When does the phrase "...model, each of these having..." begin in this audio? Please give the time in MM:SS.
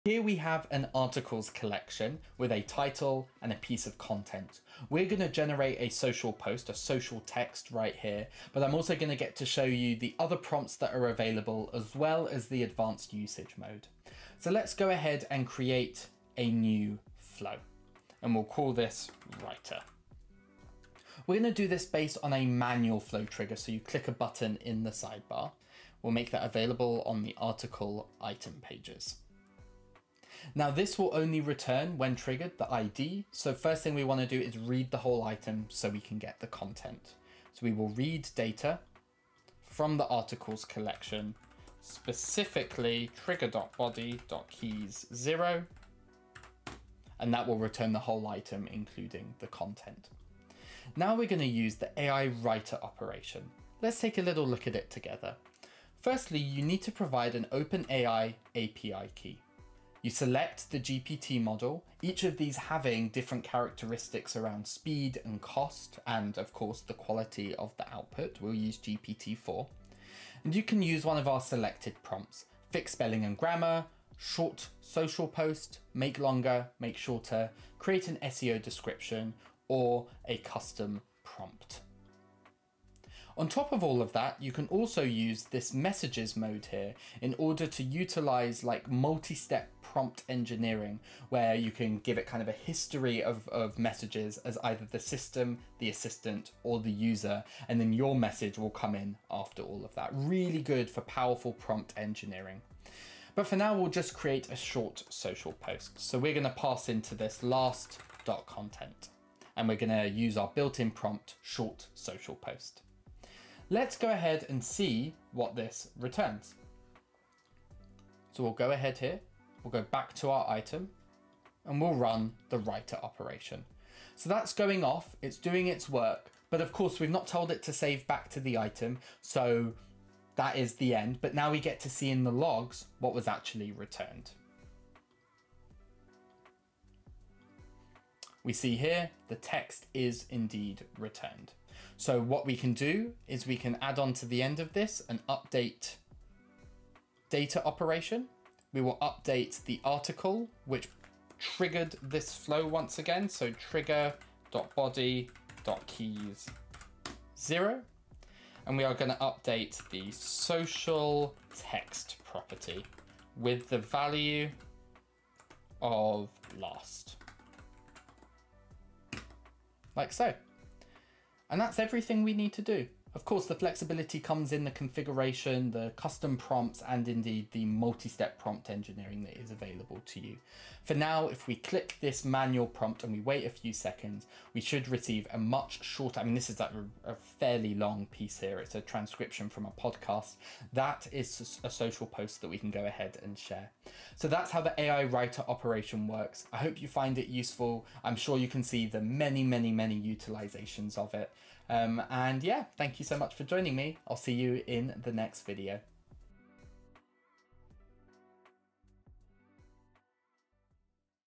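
01:01.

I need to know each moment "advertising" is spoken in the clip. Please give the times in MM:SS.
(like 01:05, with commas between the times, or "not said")
not said.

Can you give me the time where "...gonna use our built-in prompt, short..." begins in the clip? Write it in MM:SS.
01:49.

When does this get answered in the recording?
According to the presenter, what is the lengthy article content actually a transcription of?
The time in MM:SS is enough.
03:09.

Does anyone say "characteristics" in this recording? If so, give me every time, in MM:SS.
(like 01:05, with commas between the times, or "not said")
01:03.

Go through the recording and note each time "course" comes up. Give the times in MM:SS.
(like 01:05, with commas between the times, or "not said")
01:06, 02:06, 02:53.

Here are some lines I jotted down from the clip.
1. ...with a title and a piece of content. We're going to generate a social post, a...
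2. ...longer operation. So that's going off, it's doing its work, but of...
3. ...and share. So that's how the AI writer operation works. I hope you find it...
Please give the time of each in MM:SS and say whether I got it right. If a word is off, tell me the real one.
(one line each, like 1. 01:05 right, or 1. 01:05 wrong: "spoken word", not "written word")
1. 00:02 right
2. 02:02 wrong: "writer", not "longer"
3. 03:13 right.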